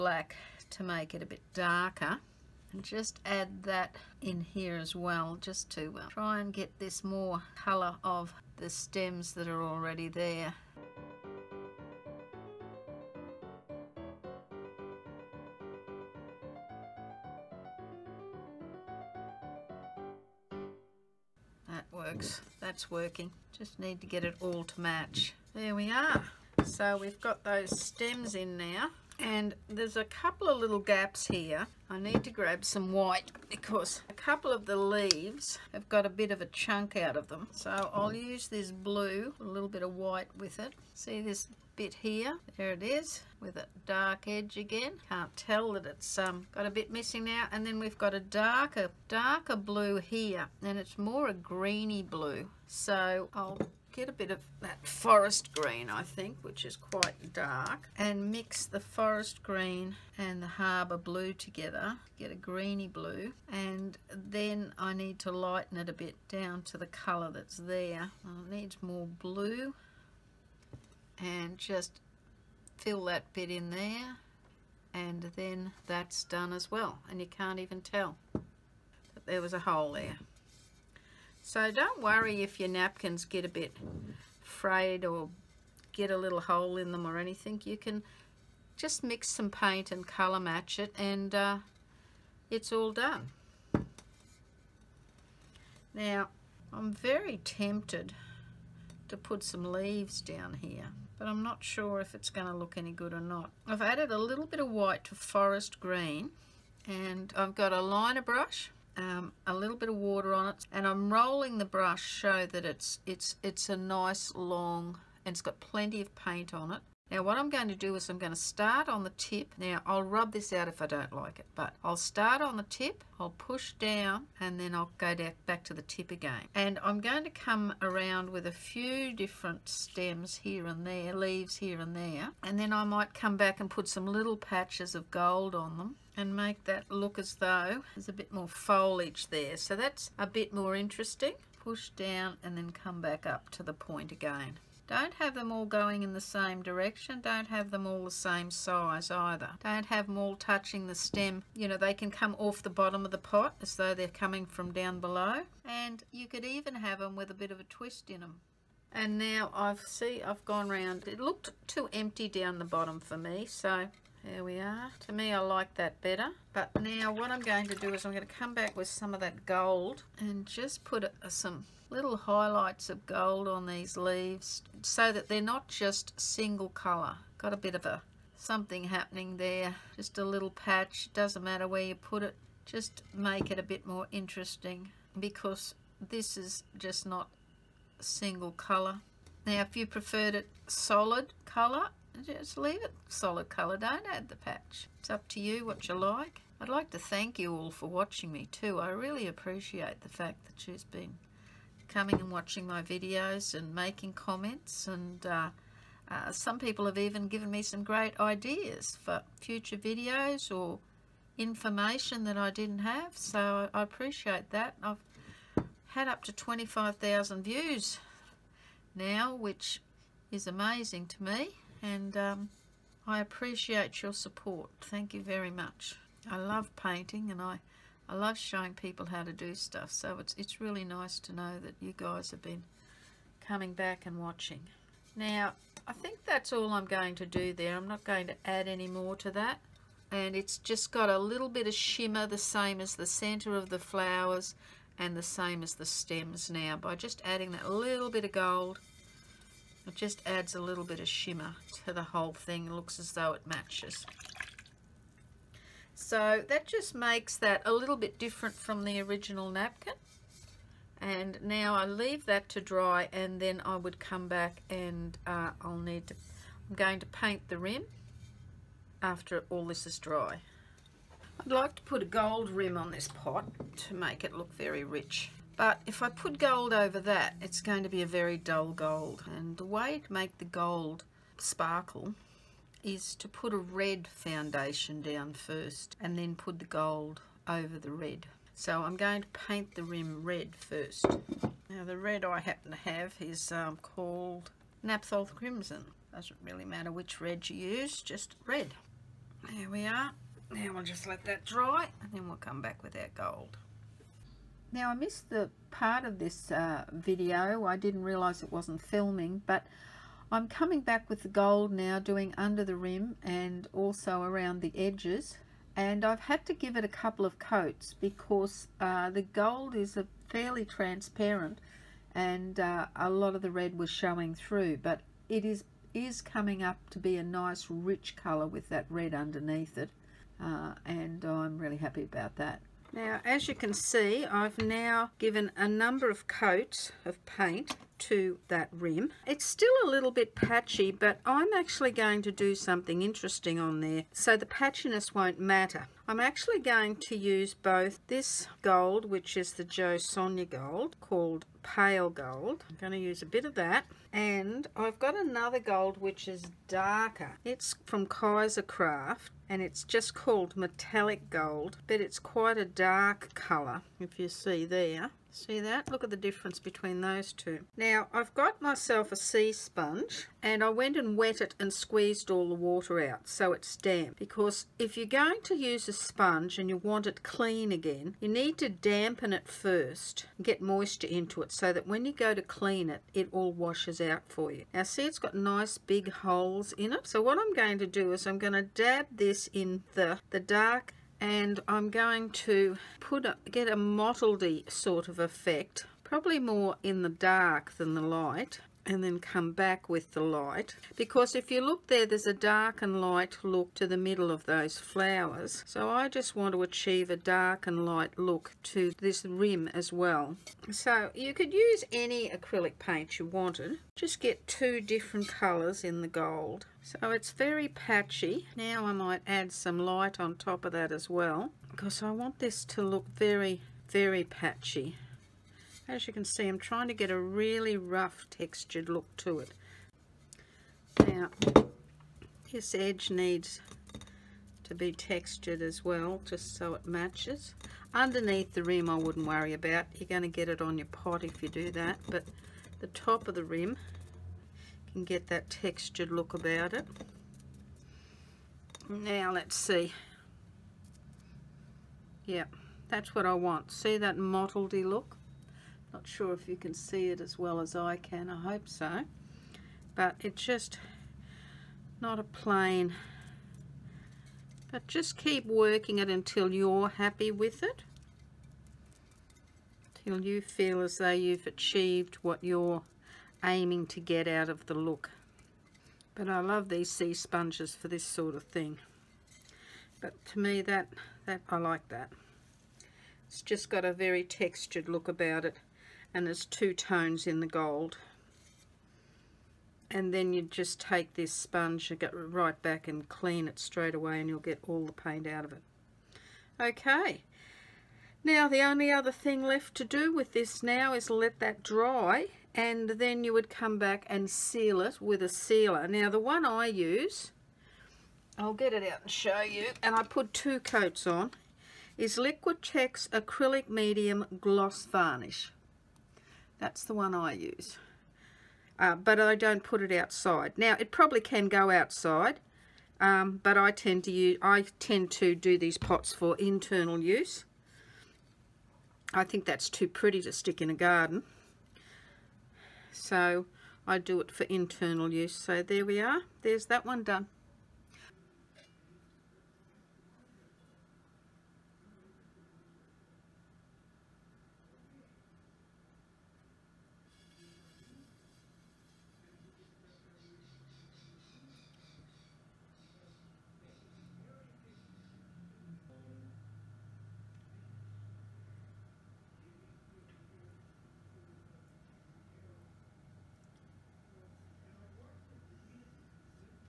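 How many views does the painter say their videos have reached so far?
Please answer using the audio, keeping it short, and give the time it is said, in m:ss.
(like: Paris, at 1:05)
25,000, at 3:36.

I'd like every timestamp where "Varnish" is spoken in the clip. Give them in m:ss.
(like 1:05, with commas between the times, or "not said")
8:34.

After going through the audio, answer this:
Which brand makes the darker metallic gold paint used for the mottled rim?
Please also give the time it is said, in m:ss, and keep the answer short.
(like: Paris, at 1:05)
Kaiser Craft, at 5:58.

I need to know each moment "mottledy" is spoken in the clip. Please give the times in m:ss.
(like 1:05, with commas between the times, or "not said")
6:33, 7:34.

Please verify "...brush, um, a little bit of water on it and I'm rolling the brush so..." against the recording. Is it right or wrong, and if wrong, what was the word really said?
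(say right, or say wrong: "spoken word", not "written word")
right.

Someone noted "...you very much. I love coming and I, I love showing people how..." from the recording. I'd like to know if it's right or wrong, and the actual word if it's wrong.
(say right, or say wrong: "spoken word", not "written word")
wrong: "painting", not "coming".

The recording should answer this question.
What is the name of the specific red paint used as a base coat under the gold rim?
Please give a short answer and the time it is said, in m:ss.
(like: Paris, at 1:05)
Napthol Crimson, at 4:54.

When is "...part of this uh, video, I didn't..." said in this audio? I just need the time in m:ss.
5:05.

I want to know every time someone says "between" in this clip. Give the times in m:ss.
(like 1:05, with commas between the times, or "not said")
6:06.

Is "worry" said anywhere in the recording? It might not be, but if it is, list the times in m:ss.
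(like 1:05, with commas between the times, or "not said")
1:22, 7:19.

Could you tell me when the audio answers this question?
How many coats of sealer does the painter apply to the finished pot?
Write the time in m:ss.
8:30.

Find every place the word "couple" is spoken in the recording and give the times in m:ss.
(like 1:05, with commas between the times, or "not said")
0:30, 0:34, 5:16.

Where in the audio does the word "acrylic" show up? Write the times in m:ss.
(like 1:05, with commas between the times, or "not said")
6:52, 8:33.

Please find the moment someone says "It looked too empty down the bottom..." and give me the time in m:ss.
2:41.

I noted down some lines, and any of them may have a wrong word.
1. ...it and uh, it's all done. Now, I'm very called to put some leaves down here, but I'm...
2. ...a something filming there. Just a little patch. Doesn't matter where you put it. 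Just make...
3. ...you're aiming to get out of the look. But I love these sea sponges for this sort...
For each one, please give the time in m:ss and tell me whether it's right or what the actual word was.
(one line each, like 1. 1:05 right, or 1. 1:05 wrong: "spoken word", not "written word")
1. 1:30 wrong: "tempted", not "called"
2. 2:57 wrong: "happening", not "filming"
3. 7:52 right.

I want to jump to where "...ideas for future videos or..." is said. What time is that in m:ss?
3:28.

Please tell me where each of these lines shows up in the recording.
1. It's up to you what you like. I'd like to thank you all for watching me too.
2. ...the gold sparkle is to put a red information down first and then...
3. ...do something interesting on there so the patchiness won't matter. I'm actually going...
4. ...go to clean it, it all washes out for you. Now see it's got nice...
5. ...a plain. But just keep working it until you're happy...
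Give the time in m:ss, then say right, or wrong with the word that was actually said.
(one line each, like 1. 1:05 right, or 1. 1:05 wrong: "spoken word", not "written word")
1. 3:14 right
2. 4:40 wrong: "foundation", not "information"
3. 5:42 right
4. 6:22 right
5. 7:42 right.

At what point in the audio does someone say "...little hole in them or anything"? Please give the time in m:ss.
1:26.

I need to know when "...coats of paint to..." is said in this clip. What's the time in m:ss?
5:36.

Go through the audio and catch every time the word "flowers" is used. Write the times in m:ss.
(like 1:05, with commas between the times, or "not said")
4:03, 6:44.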